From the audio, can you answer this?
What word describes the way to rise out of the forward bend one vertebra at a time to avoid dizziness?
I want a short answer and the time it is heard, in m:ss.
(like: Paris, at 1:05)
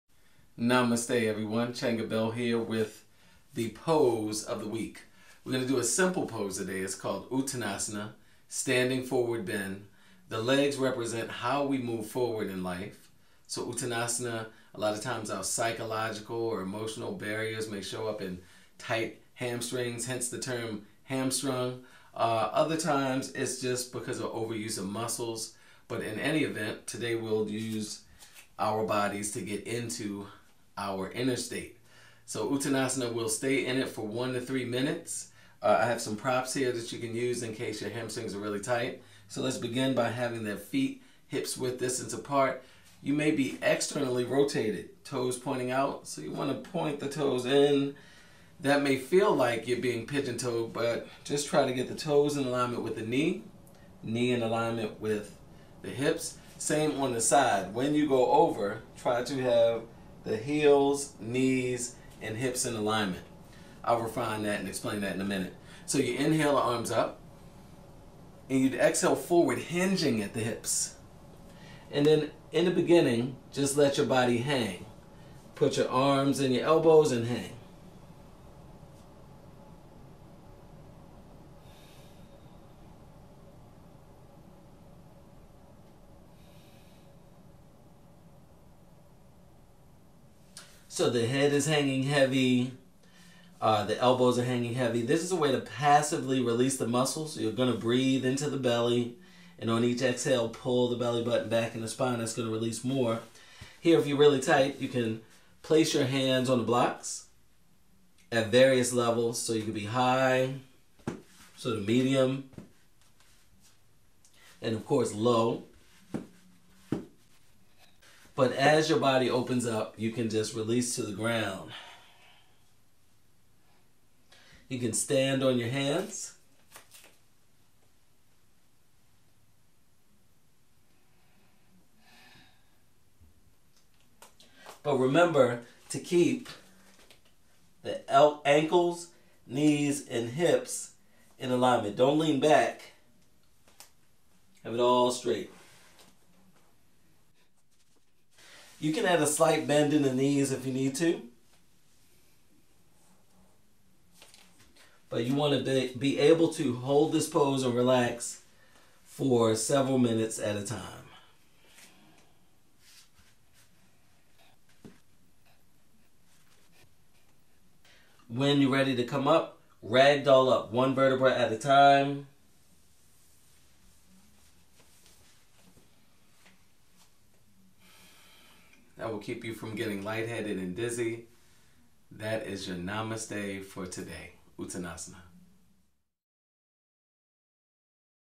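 ragdoll, at 2:49.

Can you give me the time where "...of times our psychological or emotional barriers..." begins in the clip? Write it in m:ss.
0:14.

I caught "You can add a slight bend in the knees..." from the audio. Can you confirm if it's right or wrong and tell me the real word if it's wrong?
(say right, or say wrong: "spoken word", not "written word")
right.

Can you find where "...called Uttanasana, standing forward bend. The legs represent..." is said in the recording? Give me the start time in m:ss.
0:06.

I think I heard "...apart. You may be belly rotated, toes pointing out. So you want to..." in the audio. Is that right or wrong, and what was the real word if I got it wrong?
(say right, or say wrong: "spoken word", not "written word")
wrong: "externally", not "belly".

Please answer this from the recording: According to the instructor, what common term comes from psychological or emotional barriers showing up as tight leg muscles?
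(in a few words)
hamstrung.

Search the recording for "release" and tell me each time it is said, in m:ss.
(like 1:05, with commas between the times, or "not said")
1:36, 1:42, 2:00.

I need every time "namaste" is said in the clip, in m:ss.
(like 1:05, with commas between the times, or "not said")
0:00, 3:02.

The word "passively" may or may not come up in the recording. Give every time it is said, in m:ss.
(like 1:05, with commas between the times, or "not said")
1:35.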